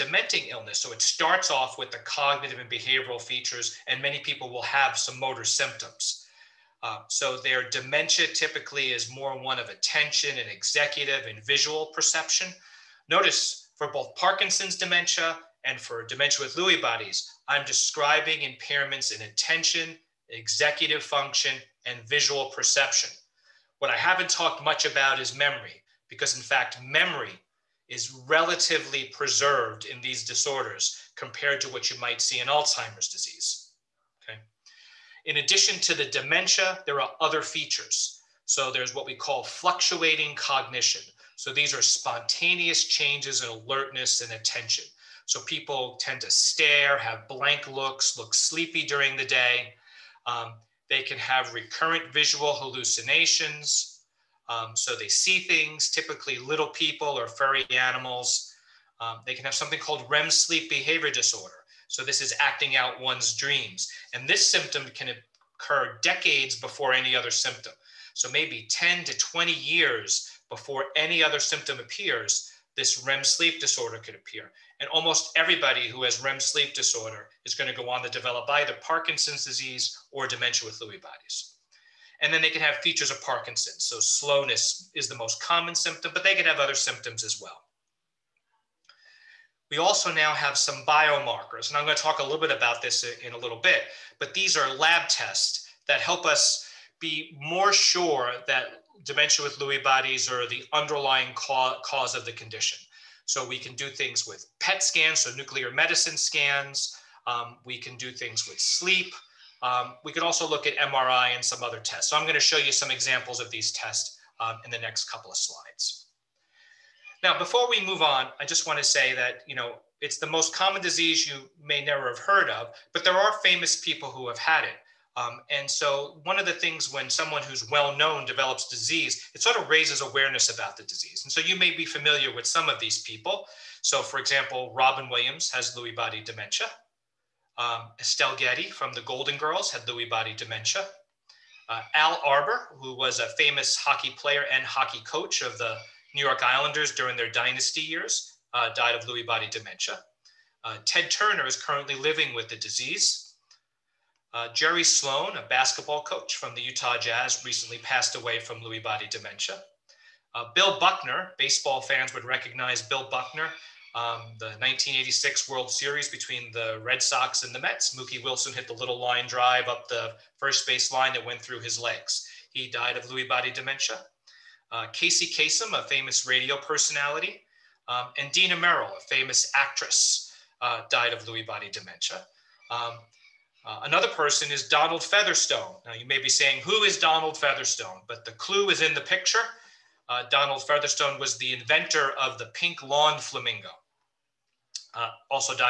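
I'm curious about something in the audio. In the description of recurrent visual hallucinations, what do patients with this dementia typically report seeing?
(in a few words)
little people or furry animals.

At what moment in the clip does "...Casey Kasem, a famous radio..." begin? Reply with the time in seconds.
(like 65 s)
174 s.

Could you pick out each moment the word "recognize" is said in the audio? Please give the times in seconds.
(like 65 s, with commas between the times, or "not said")
162 s.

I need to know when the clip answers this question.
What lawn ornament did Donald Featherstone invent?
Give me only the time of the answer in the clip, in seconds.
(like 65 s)
192 s.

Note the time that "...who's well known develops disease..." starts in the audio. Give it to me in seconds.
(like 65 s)
127 s.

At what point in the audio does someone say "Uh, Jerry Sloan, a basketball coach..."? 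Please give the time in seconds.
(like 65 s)
154 s.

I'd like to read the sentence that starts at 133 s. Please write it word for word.
So, for example, Robin Williams has Lewy body dementia.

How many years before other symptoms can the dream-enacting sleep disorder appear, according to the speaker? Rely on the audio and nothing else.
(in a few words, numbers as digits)
10 to 20 years.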